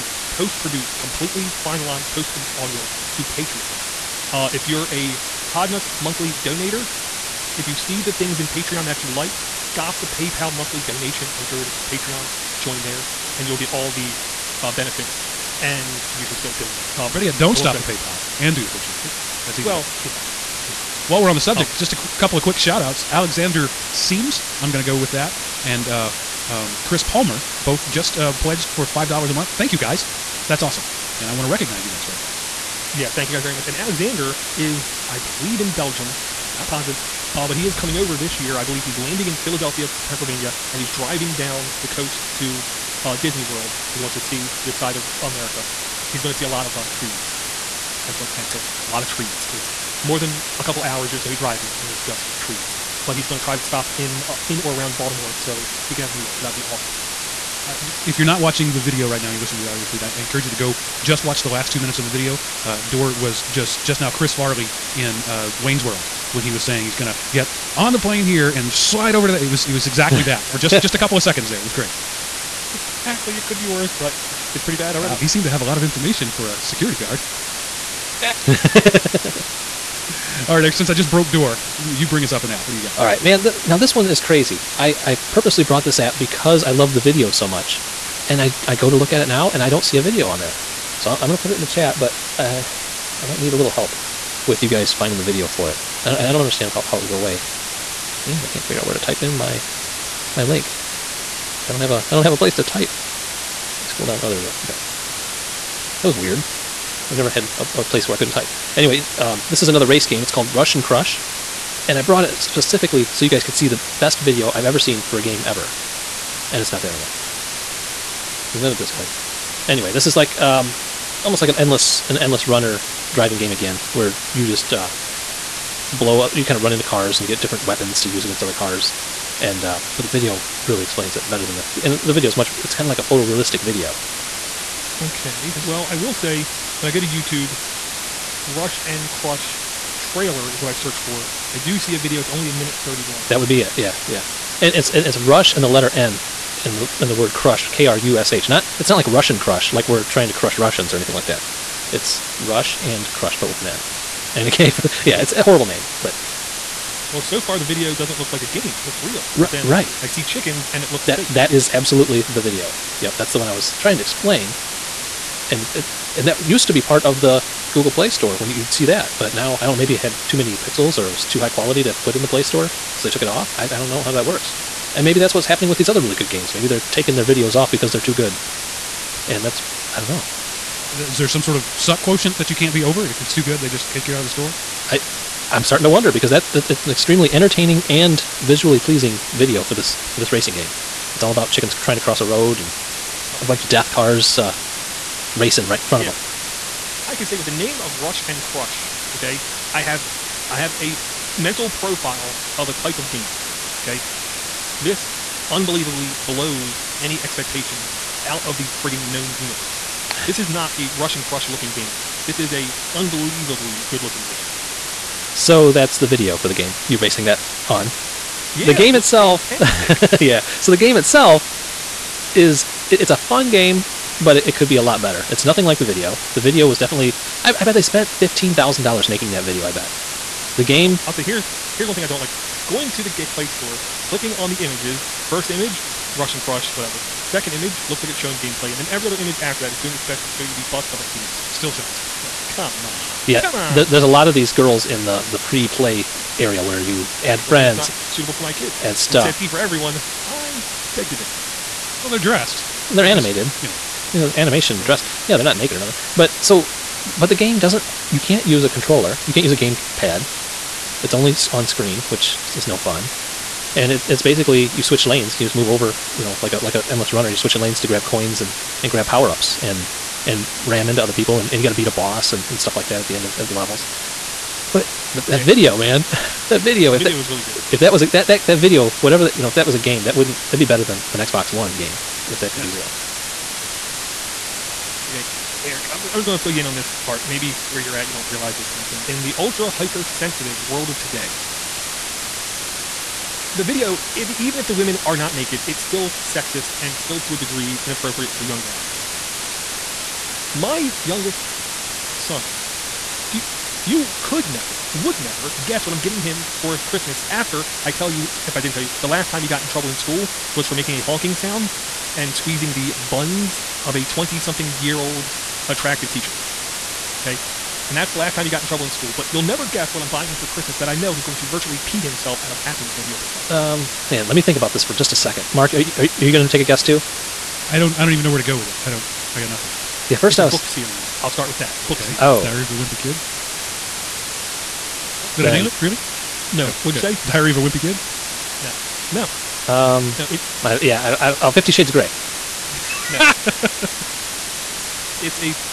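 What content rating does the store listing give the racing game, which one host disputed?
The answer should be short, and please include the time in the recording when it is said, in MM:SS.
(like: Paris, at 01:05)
E for everyone, at 04:09.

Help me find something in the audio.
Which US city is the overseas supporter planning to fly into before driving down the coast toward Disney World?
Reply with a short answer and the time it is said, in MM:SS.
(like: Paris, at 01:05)
Philadelphia, at 00:39.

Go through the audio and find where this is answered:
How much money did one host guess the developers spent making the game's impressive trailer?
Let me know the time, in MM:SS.
03:48.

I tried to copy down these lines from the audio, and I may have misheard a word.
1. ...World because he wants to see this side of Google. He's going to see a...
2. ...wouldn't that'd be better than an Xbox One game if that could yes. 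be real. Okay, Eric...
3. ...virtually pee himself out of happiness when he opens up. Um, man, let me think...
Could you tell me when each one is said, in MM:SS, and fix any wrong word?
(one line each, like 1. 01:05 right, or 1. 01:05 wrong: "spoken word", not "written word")
1. 00:43 wrong: "America", not "Google"
2. 04:40 right
3. 05:21 right.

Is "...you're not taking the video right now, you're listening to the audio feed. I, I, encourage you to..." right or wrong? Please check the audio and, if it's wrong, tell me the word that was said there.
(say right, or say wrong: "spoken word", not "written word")
wrong: "watching", not "taking".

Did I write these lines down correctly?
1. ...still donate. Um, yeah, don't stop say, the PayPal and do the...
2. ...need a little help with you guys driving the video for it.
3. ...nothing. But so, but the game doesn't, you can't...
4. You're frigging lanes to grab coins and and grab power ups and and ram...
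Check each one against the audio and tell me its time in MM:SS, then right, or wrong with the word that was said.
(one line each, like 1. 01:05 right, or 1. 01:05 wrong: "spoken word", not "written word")
1. 00:16 right
2. 01:33 wrong: "finding", not "driving"
3. 04:15 right
4. 04:27 wrong: "switching", not "frigging".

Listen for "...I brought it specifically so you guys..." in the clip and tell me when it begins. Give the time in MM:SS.
01:51.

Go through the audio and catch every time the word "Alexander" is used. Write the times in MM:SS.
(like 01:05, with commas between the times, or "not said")
00:23, 00:33.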